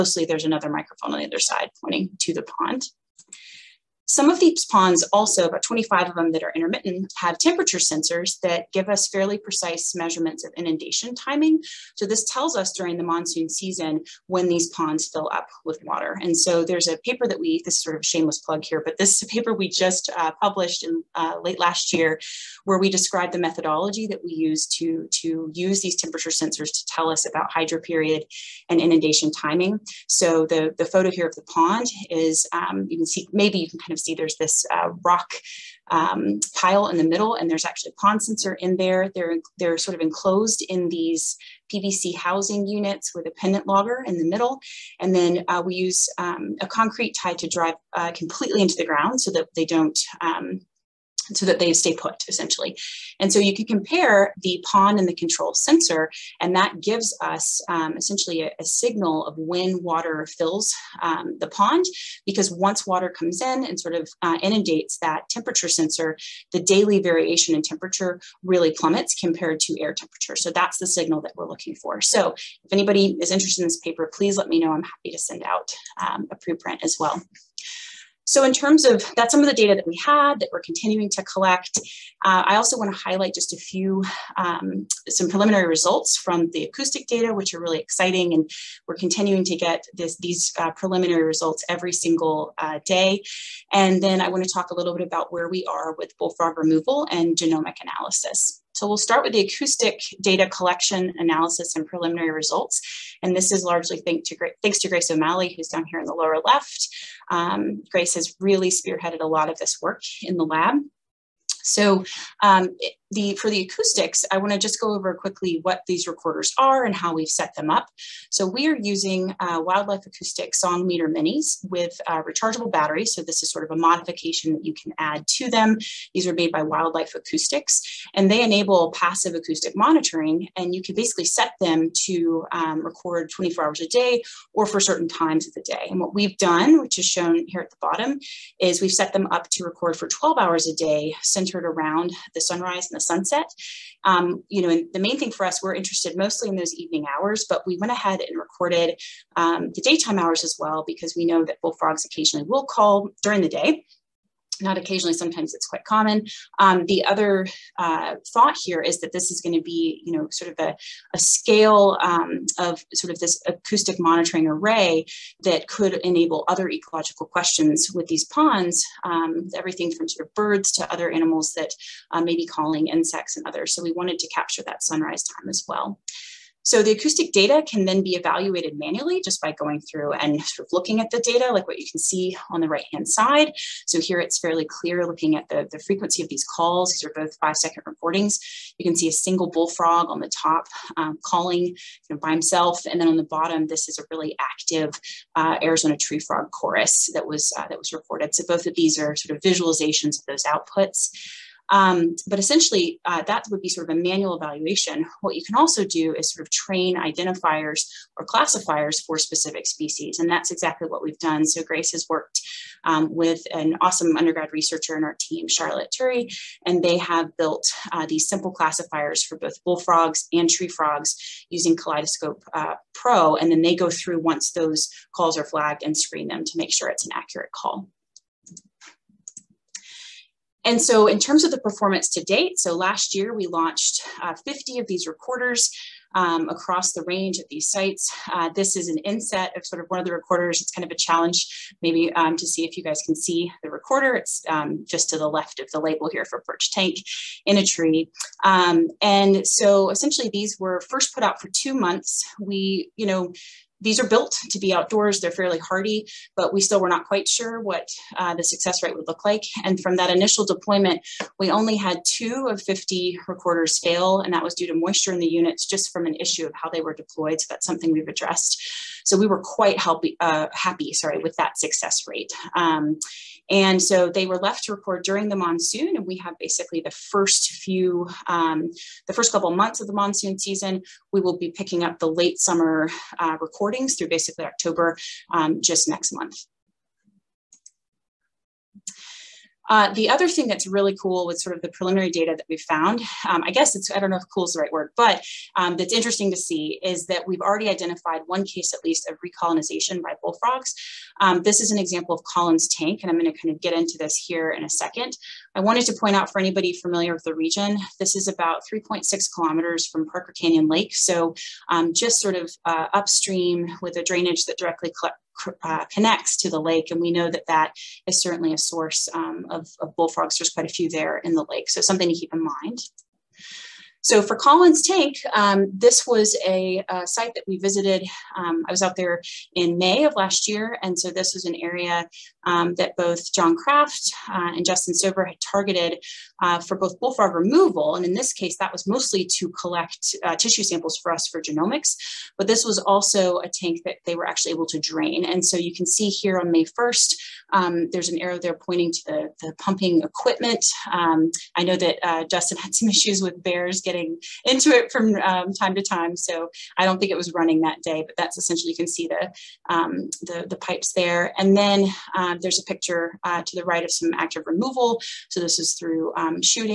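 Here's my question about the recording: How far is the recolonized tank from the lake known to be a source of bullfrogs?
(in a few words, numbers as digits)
3.6 kilometers.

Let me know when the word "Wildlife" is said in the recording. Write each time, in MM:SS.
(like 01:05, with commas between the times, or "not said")
01:59, 02:06.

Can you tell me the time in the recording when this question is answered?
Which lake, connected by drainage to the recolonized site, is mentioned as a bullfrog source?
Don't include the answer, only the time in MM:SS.
05:10.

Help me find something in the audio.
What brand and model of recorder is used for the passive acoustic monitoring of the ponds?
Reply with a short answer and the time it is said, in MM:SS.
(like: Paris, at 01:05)
Song Meter Minis, at 02:00.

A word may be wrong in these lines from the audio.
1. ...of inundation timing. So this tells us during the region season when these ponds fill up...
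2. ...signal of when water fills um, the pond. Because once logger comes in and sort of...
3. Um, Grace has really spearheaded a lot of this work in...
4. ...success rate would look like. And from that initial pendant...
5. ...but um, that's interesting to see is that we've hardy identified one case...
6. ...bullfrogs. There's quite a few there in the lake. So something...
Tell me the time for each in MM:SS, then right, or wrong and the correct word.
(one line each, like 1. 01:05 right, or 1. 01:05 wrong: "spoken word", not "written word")
1. 00:10 wrong: "monsoon", not "region"
2. 00:58 wrong: "water", not "logger"
3. 01:47 right
4. 04:18 wrong: "deployment", not "pendant"
5. 04:54 wrong: "already", not "hardy"
6. 05:19 right.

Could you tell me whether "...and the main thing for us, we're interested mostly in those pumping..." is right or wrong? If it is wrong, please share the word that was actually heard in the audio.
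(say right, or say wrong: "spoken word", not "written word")
wrong: "evening", not "pumping".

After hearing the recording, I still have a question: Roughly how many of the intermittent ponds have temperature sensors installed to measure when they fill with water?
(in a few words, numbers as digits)
25.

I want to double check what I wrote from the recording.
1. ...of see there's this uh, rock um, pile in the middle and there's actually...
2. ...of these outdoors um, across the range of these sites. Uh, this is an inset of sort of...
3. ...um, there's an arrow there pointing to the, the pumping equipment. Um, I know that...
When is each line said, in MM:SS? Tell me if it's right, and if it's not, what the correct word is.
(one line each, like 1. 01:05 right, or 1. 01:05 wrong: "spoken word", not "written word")
1. 00:33 right
2. 03:54 wrong: "recorders", not "outdoors"
3. 05:47 right.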